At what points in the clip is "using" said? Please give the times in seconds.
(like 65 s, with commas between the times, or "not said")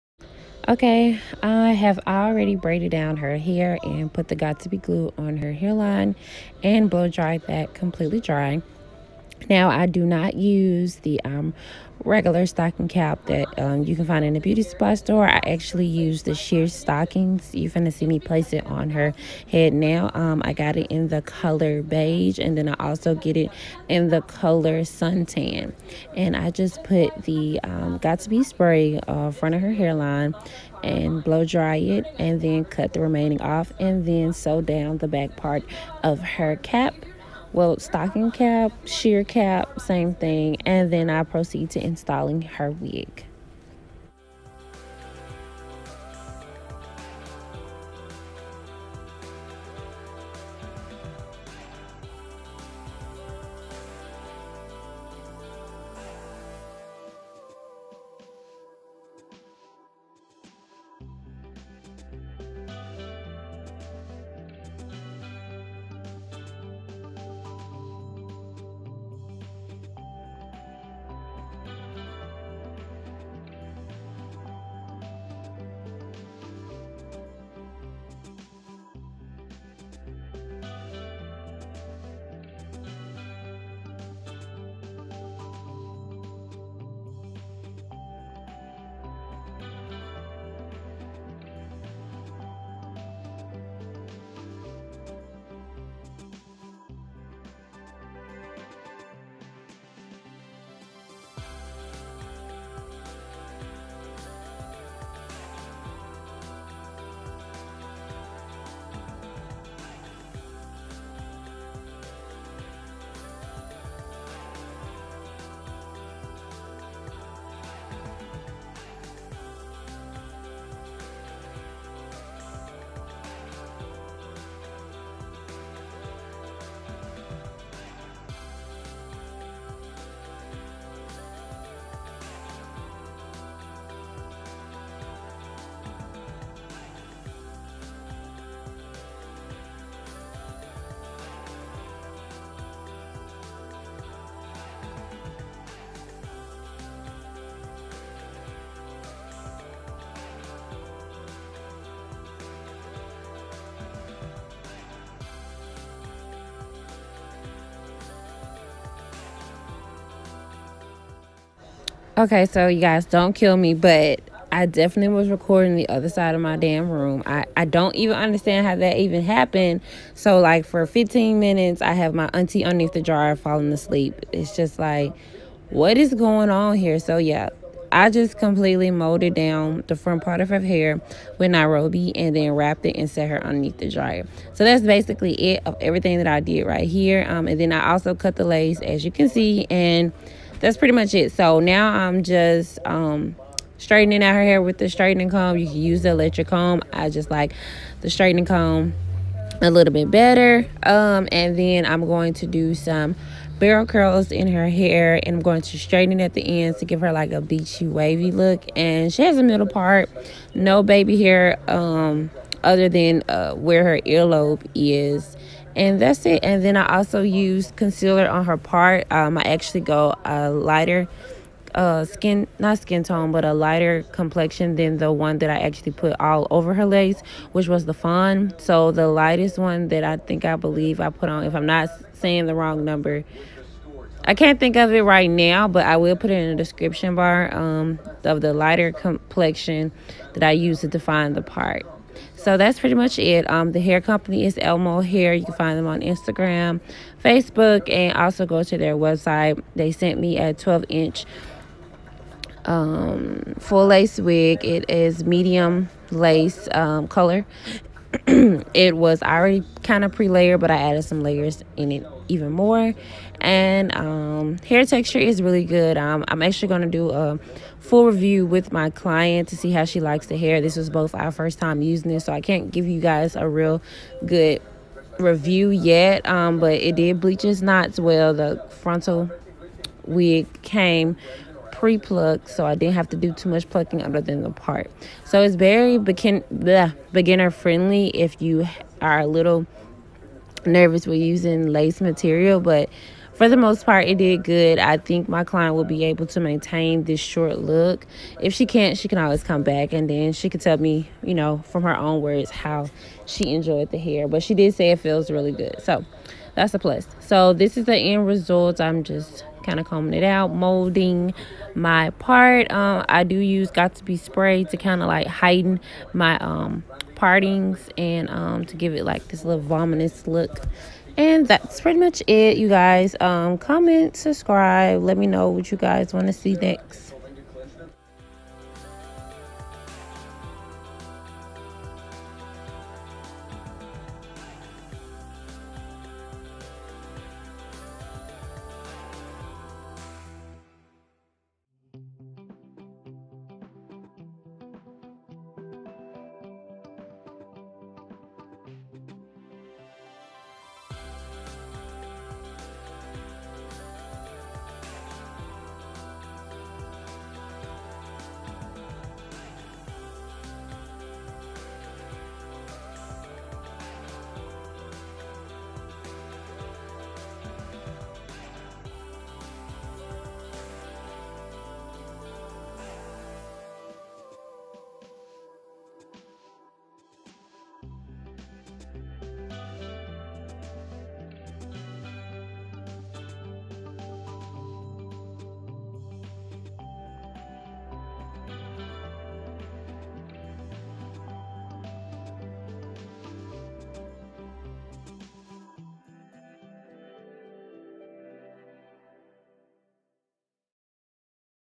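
271 s, 291 s.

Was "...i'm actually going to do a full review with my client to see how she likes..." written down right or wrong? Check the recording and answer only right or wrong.
right.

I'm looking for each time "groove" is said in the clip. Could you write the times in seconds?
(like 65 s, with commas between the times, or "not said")
not said.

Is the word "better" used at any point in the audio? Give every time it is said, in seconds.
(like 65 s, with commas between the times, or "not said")
200 s.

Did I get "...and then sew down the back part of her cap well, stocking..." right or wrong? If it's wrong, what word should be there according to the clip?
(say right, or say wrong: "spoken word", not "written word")
right.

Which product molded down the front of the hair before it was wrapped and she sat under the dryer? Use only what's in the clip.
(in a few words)
Nairobi.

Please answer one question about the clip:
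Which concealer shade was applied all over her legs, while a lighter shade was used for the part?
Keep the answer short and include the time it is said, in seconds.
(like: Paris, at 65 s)
fawn, at 227 s.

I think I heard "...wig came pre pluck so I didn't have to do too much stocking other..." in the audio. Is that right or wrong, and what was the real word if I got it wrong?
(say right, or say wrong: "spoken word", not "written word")
wrong: "plucking", not "stocking".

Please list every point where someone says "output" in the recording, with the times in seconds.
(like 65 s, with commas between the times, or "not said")
not said.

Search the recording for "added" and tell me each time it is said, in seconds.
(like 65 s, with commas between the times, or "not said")
260 s.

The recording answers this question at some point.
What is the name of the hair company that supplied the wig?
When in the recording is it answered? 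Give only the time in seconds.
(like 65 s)
244 s.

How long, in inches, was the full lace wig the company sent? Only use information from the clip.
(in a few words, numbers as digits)
12 inches.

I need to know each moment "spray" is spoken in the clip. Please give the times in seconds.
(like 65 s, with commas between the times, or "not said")
28 s, 314 s.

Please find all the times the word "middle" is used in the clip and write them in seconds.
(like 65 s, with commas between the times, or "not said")
209 s.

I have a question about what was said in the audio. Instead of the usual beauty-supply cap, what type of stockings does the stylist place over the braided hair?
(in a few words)
sheer stockings.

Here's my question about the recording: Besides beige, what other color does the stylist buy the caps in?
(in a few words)
suntan.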